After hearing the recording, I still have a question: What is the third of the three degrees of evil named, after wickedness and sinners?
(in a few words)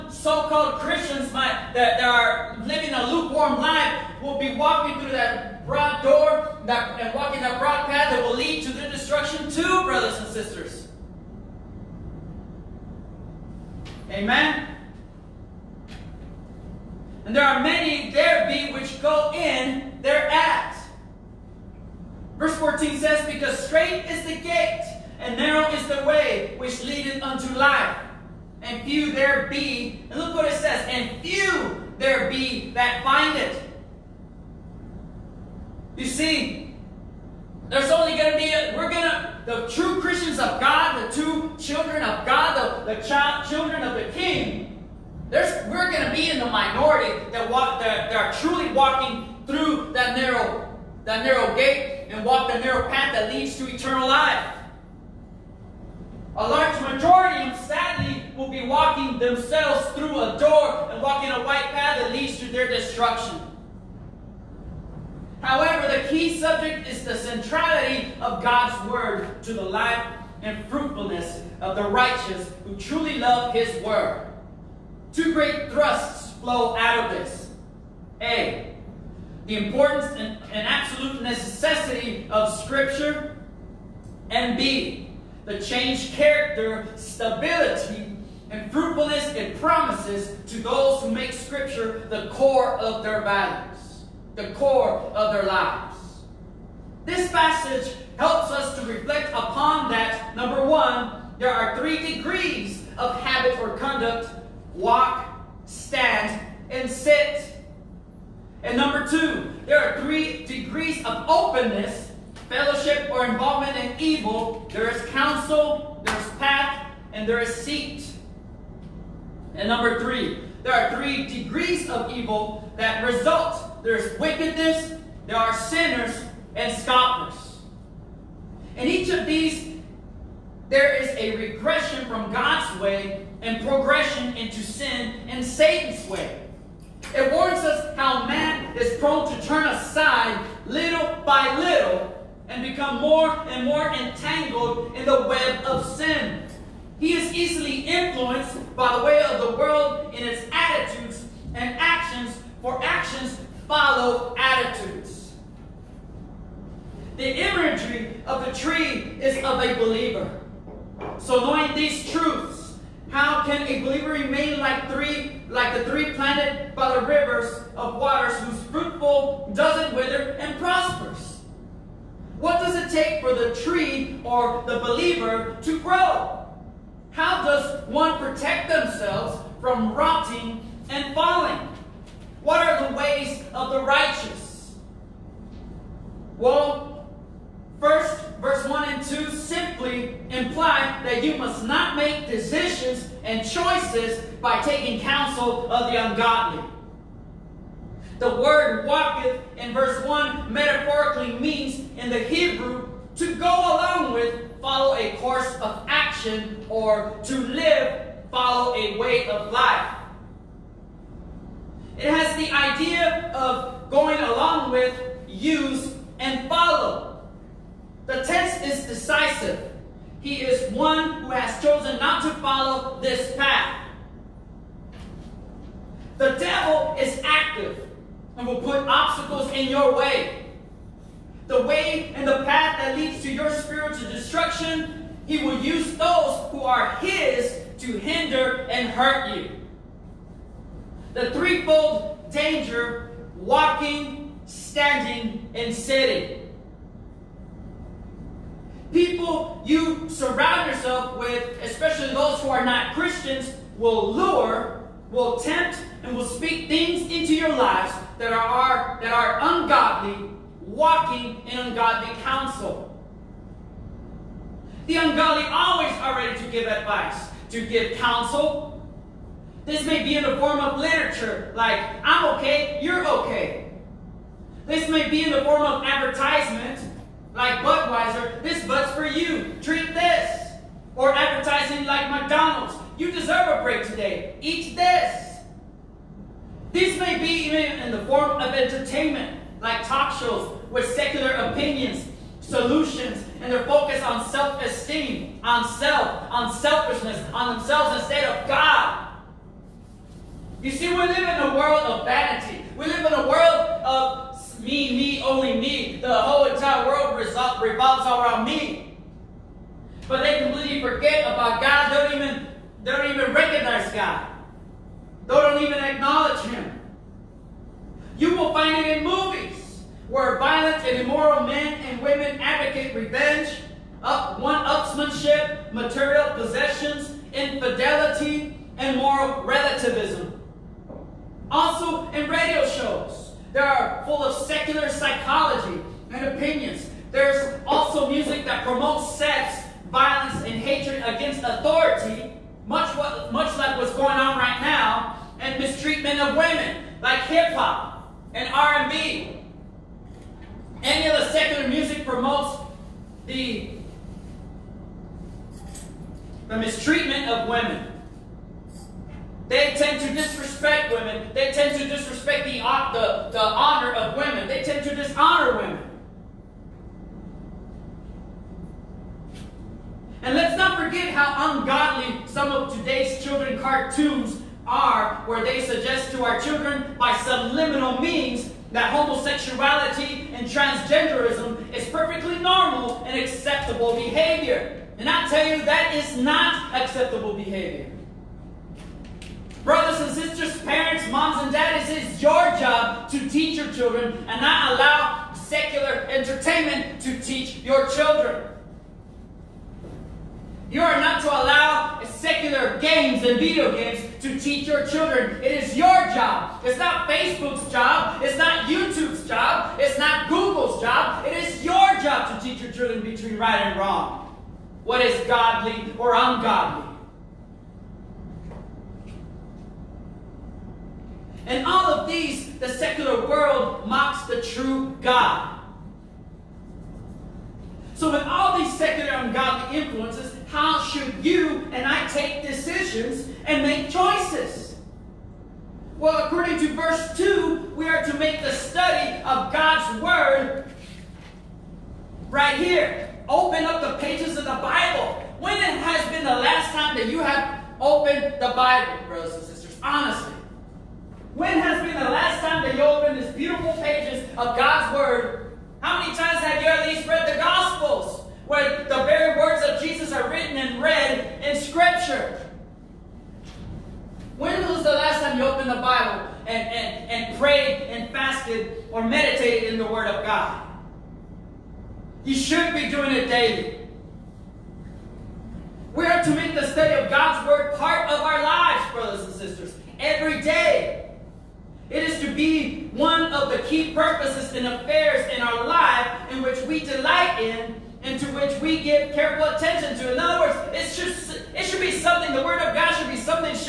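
scoffers.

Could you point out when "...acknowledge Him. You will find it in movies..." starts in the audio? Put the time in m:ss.
5:15.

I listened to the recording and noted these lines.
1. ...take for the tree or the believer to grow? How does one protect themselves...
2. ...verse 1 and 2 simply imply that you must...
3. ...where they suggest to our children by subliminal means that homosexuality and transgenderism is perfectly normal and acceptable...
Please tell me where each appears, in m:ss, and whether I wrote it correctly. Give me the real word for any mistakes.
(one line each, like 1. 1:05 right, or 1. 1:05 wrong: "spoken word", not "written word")
1. 2:52 right
2. 3:08 right
3. 6:15 right.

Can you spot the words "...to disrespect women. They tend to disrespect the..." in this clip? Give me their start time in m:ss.
6:00.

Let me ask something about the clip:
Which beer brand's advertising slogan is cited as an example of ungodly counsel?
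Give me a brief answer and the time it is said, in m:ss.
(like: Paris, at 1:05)
Budweiser, at 4:37.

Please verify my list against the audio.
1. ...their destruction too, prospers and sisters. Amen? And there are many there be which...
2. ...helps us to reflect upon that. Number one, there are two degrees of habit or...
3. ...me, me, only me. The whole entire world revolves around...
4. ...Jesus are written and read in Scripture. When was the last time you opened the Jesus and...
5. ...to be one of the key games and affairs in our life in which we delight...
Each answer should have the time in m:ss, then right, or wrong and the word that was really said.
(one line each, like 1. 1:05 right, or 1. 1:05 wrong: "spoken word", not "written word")
1. 0:08 wrong: "brothers", not "prospers"
2. 1:38 wrong: "three", not "two"
3. 5:04 right
4. 7:39 wrong: "Bible", not "Jesus"
5. 8:02 wrong: "purposes", not "games".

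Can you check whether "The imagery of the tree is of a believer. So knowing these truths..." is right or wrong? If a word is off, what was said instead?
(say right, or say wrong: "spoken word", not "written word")
right.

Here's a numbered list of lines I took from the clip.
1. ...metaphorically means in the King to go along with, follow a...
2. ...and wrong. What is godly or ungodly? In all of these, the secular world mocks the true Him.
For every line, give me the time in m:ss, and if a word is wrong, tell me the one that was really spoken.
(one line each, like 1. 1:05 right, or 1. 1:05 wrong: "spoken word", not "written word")
1. 3:20 wrong: "Hebrew", not "King"
2. 6:53 wrong: "God", not "Him".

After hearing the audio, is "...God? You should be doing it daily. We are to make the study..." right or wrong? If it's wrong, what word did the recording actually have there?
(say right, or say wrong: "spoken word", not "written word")
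right.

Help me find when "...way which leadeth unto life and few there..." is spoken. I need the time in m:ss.
0:26.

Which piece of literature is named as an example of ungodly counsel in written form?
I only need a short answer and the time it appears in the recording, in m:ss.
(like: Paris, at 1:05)
I'm okay, you're okay, at 4:32.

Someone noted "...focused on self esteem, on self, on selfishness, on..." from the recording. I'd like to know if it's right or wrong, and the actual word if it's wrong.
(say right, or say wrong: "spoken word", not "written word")
right.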